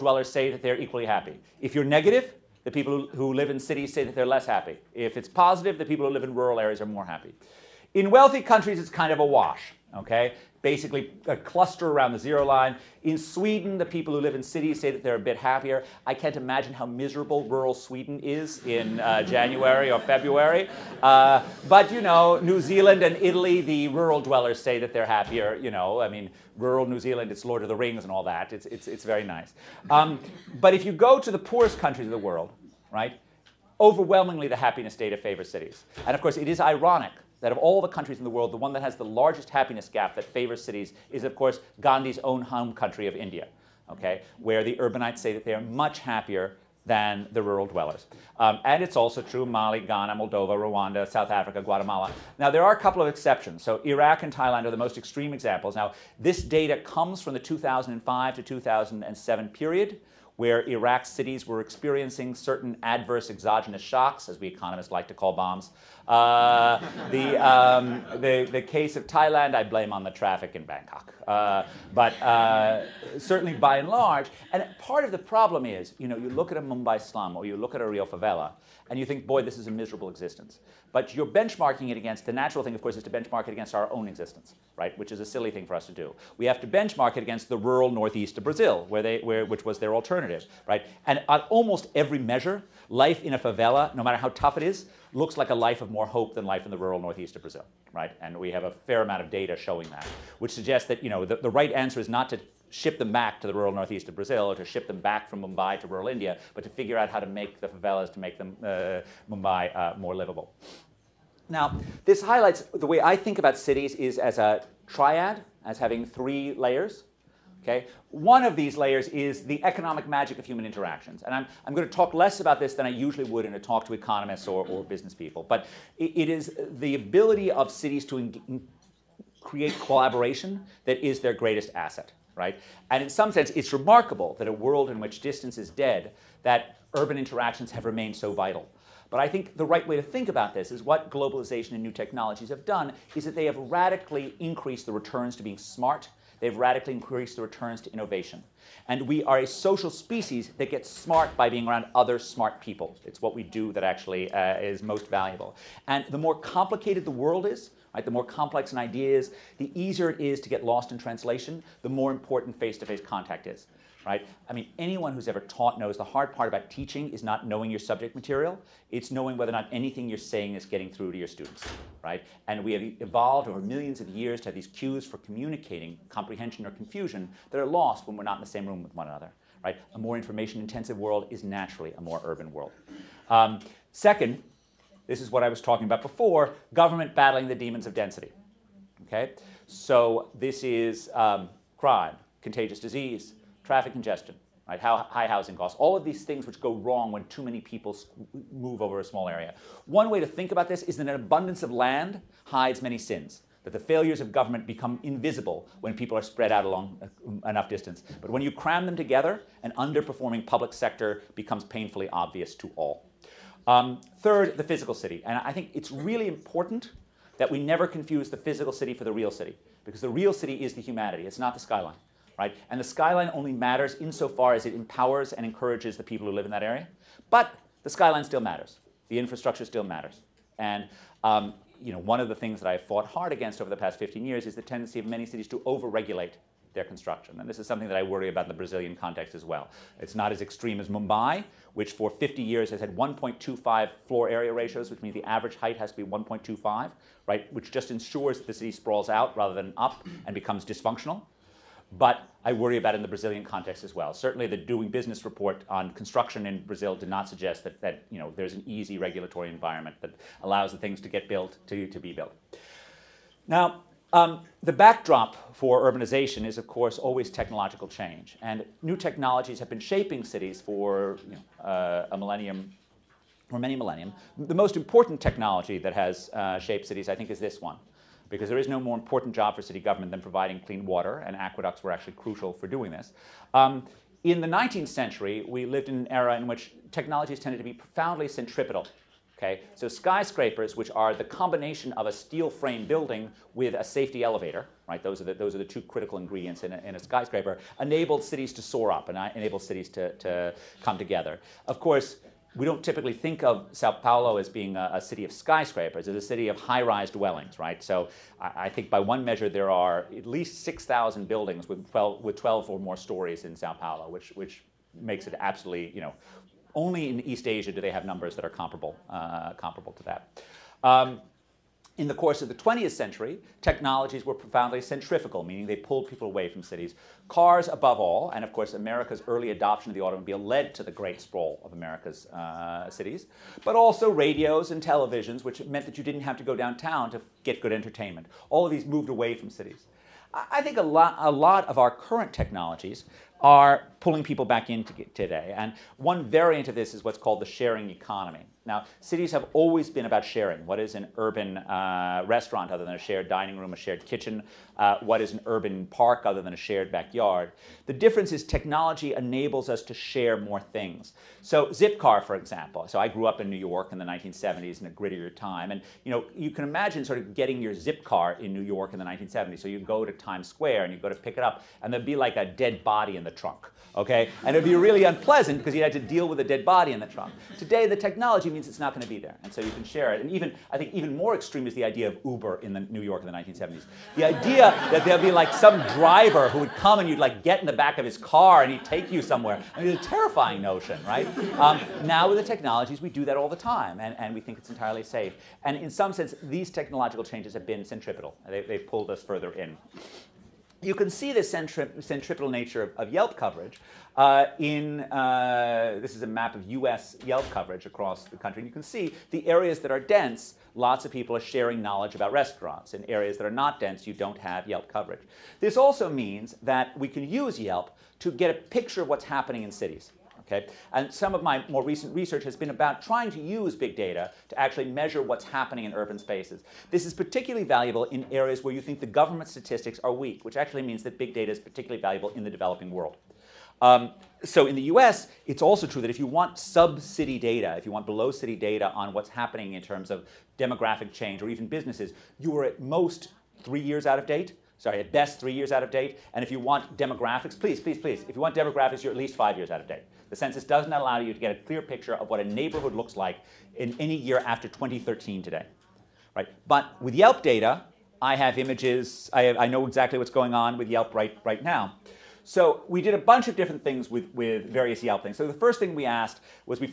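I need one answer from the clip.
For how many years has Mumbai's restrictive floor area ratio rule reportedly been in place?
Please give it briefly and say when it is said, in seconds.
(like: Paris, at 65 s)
50 years, at 242 s.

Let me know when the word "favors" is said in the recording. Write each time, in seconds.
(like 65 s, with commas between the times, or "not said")
35 s, 40 s.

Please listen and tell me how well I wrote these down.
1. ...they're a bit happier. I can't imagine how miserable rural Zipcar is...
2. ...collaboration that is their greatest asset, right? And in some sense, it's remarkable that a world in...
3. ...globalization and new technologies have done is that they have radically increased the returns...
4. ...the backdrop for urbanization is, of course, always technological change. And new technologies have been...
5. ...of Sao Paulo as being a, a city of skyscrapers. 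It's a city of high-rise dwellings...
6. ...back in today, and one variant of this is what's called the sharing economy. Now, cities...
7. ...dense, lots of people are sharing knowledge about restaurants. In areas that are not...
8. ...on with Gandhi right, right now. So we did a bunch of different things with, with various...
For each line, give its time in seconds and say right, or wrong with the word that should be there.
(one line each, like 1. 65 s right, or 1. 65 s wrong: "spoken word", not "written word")
1. 15 s wrong: "Sweden", not "Zipcar"
2. 129 s right
3. 141 s right
4. 264 s right
5. 303 s right
6. 344 s right
7. 409 s right
8. 460 s wrong: "Yelp", not "Gandhi".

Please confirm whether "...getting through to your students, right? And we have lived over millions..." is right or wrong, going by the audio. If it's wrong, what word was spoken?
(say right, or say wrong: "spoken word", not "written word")
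wrong: "evolved", not "lived".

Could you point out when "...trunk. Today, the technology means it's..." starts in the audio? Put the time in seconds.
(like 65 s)
377 s.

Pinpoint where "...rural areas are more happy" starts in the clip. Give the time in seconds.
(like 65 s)
6 s.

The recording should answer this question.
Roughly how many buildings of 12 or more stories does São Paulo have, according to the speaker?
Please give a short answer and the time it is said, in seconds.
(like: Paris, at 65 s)
6,000, at 310 s.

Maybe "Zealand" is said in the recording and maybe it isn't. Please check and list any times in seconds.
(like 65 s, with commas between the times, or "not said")
22 s, 26 s.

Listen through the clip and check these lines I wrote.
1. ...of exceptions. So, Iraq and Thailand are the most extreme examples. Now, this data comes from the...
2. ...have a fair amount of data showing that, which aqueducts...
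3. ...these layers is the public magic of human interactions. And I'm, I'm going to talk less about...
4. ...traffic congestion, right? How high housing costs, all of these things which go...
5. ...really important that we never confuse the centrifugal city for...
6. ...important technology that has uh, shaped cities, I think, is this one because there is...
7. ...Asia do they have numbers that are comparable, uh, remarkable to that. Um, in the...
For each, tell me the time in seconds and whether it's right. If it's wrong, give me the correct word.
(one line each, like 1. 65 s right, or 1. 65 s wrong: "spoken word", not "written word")
1. 53 s right
2. 98 s wrong: "suggests", not "aqueducts"
3. 118 s wrong: "economic", not "public"
4. 193 s right
5. 215 s wrong: "physical", not "centrifugal"
6. 274 s right
7. 317 s wrong: "comparable", not "remarkable".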